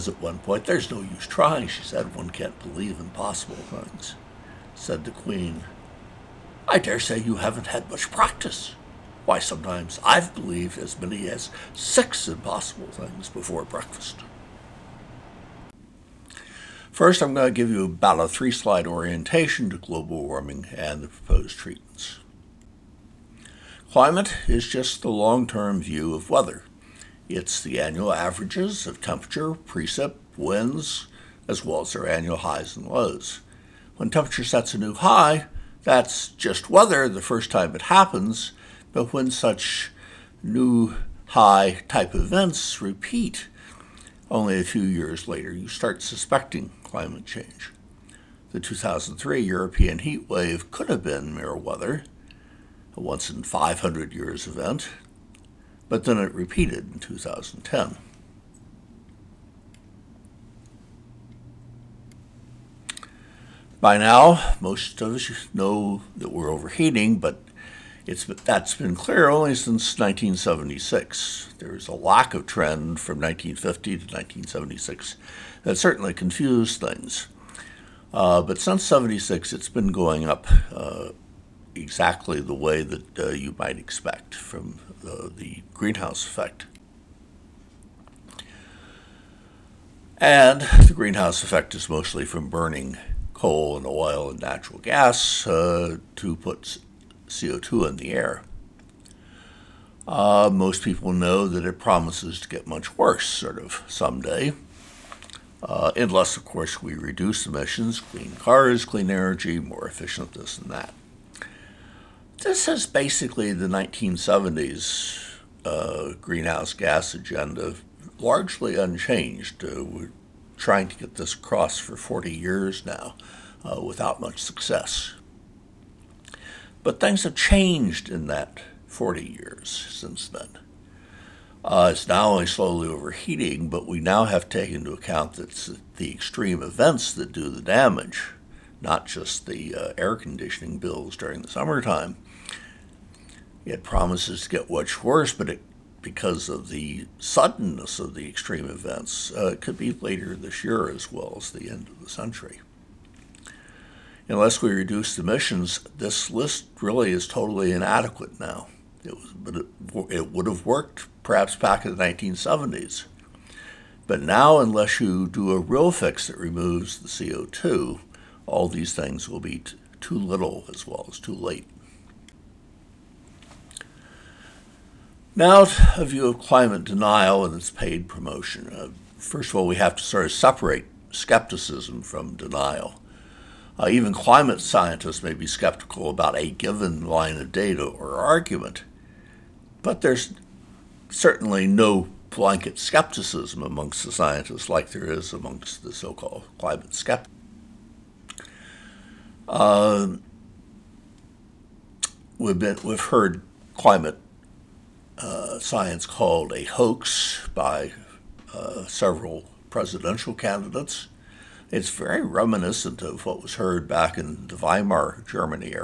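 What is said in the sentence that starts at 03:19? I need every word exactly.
Uh, we've, been, we've heard climate uh, science called a hoax by uh, several presidential candidates.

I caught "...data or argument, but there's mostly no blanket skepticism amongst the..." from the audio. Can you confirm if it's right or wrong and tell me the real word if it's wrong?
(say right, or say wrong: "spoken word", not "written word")
wrong: "certainly", not "mostly".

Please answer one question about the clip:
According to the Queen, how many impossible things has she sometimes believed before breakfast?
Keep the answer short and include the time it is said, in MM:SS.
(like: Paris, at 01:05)
6, at 00:11.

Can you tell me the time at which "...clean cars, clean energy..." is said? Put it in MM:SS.
01:47.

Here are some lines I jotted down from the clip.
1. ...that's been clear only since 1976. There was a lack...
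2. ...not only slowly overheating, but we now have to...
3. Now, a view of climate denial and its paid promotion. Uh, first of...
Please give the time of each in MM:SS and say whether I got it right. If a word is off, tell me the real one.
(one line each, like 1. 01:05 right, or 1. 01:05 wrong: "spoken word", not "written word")
1. 01:08 right
2. 02:12 right
3. 02:55 right.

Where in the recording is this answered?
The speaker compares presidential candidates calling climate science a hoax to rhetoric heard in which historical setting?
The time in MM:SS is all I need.
03:34.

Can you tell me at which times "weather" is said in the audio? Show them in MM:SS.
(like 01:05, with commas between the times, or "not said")
00:26, 00:36, 00:51.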